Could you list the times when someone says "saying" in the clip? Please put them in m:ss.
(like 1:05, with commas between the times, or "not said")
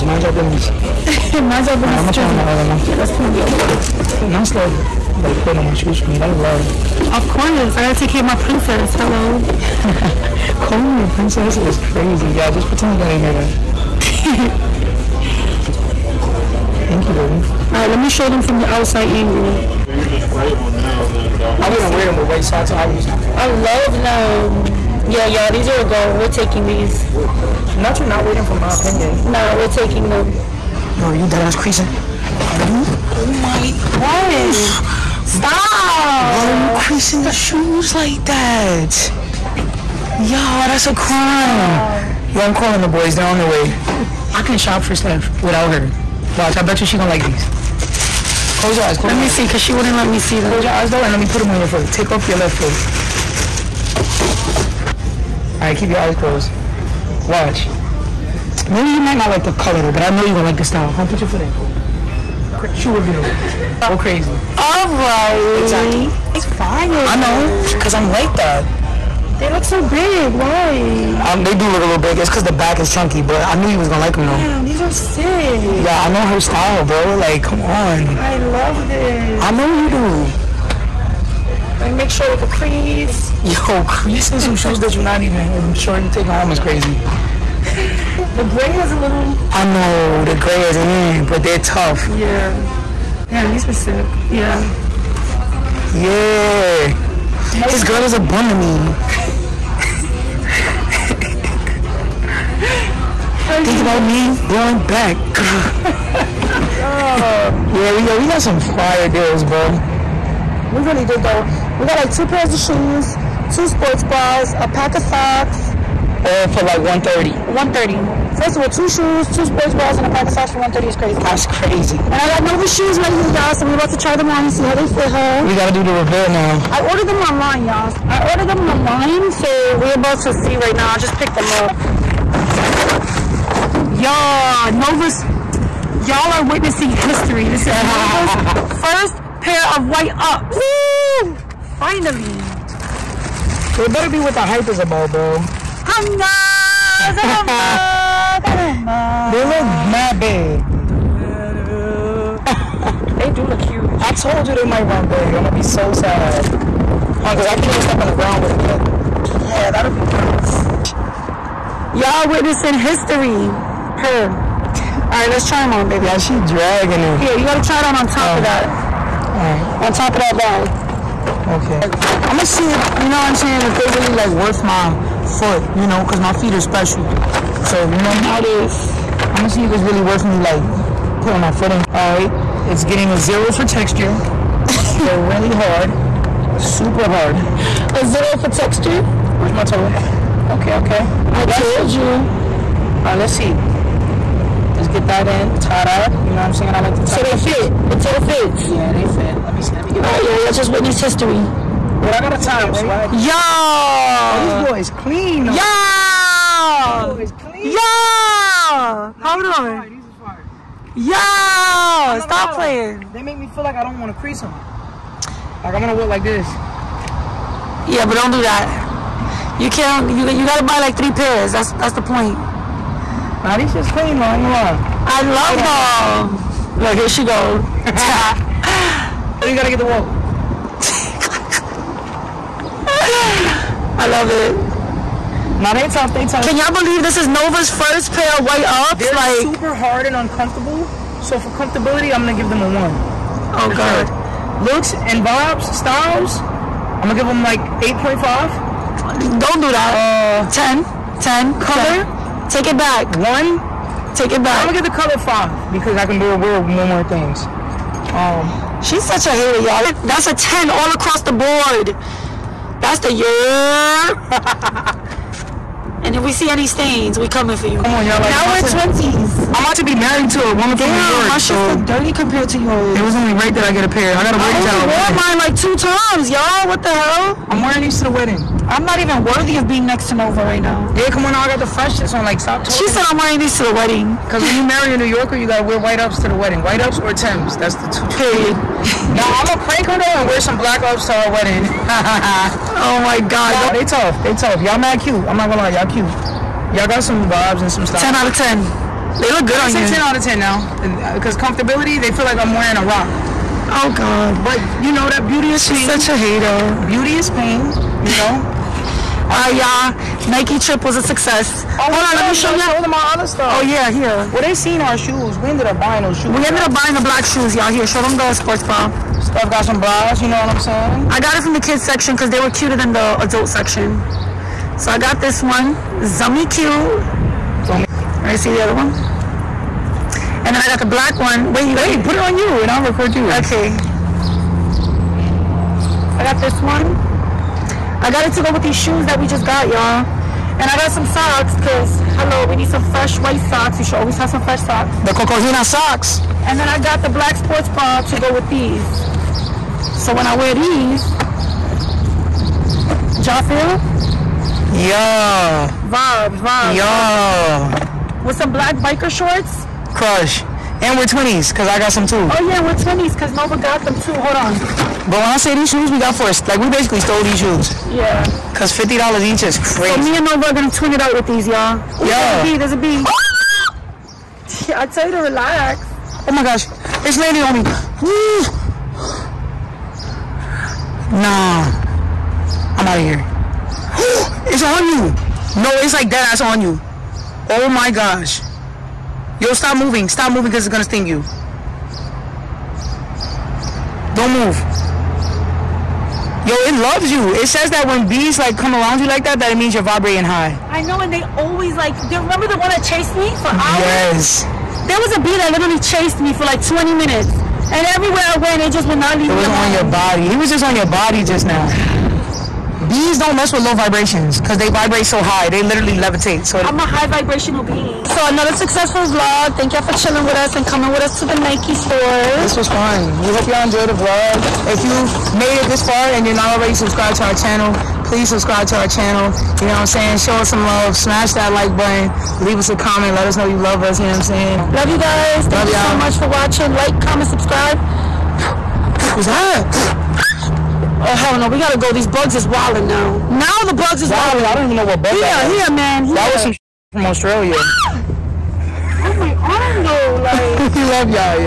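2:53, 3:16, 5:20, 7:09, 7:14.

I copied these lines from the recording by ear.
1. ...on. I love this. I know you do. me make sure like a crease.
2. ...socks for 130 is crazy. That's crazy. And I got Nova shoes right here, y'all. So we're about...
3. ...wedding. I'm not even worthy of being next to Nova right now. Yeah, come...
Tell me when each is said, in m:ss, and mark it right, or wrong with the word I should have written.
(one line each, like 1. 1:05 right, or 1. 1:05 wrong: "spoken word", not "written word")
1. 1:17 right
2. 2:00 right
3. 4:38 right.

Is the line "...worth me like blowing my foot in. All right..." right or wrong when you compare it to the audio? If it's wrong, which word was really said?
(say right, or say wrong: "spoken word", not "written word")
wrong: "putting", not "blowing".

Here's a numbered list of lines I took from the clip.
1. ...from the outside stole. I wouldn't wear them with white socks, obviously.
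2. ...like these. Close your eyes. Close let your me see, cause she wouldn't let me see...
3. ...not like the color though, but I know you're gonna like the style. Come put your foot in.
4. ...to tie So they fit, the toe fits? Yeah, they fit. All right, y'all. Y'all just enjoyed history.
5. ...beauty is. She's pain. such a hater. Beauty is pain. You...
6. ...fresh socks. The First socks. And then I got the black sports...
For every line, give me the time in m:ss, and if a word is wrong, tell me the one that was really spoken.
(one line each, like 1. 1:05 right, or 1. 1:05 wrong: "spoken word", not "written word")
1. 0:18 wrong: "angle", not "stole"
2. 0:47 right
3. 0:59 right
4. 3:16 wrong: "witnessed", not "enjoyed"
5. 5:05 right
6. 5:44 wrong: "Cocohina", not "First".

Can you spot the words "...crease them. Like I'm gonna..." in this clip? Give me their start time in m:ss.
3:34.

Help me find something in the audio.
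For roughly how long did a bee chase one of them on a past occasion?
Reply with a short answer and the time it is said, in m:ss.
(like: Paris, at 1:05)
20 minutes, at 6:46.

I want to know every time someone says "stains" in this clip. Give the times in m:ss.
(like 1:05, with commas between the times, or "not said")
4:26.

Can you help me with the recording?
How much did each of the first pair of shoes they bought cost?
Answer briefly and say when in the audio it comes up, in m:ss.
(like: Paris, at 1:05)
$50, at 6:08.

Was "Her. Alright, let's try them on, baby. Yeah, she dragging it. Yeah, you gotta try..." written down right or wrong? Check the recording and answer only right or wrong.
right.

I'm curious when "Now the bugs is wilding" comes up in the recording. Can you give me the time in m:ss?
7:23.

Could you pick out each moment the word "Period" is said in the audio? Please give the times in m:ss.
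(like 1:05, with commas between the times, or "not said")
4:48.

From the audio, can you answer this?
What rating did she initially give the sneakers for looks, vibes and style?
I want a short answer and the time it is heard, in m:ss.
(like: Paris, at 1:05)
8.5, at 4:07.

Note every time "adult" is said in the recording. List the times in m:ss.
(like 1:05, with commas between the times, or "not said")
5:23.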